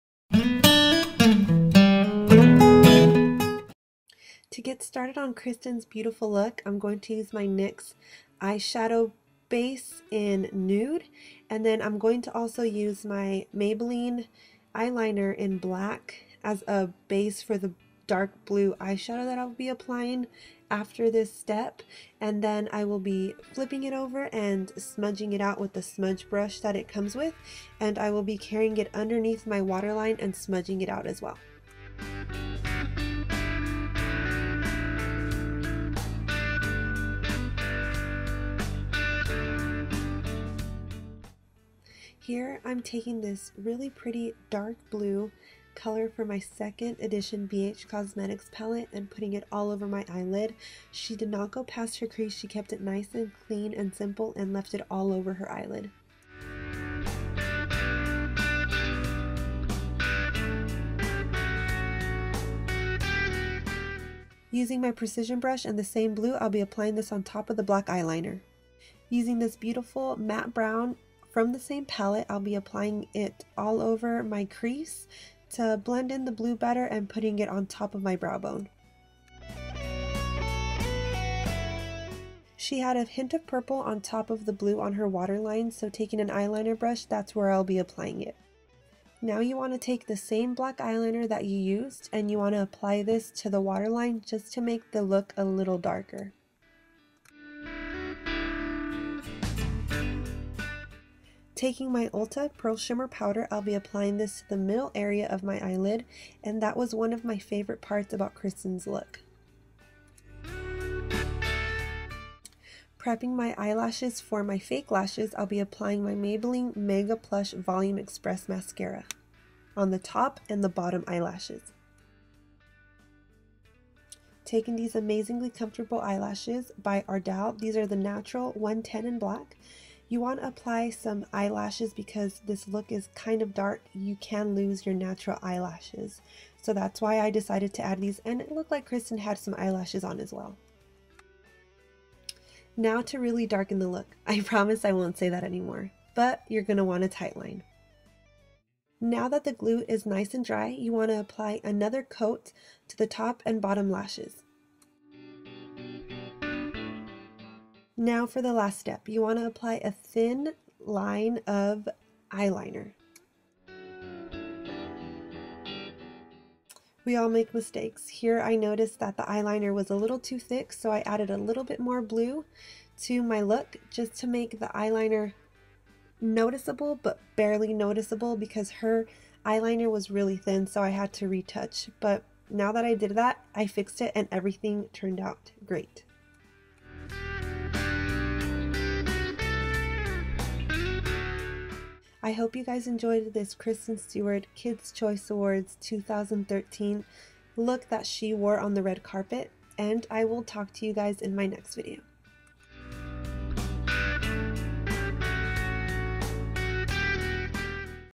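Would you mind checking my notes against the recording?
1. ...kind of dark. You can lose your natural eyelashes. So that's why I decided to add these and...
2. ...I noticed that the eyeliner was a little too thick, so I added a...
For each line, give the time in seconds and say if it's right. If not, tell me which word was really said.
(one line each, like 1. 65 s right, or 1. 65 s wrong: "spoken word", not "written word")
1. 133 s right
2. 168 s right.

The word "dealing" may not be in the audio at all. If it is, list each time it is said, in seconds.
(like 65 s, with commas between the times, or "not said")
not said.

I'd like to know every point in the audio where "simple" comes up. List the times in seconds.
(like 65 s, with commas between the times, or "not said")
53 s.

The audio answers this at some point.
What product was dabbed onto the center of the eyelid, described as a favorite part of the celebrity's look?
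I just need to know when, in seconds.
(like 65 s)
102 s.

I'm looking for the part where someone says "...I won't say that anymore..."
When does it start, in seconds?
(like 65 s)
144 s.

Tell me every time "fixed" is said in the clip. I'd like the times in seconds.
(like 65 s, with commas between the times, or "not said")
183 s.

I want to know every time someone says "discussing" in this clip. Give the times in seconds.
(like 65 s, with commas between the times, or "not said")
not said.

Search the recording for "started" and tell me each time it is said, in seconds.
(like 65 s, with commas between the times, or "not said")
4 s.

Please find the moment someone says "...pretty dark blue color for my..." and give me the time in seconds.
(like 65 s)
43 s.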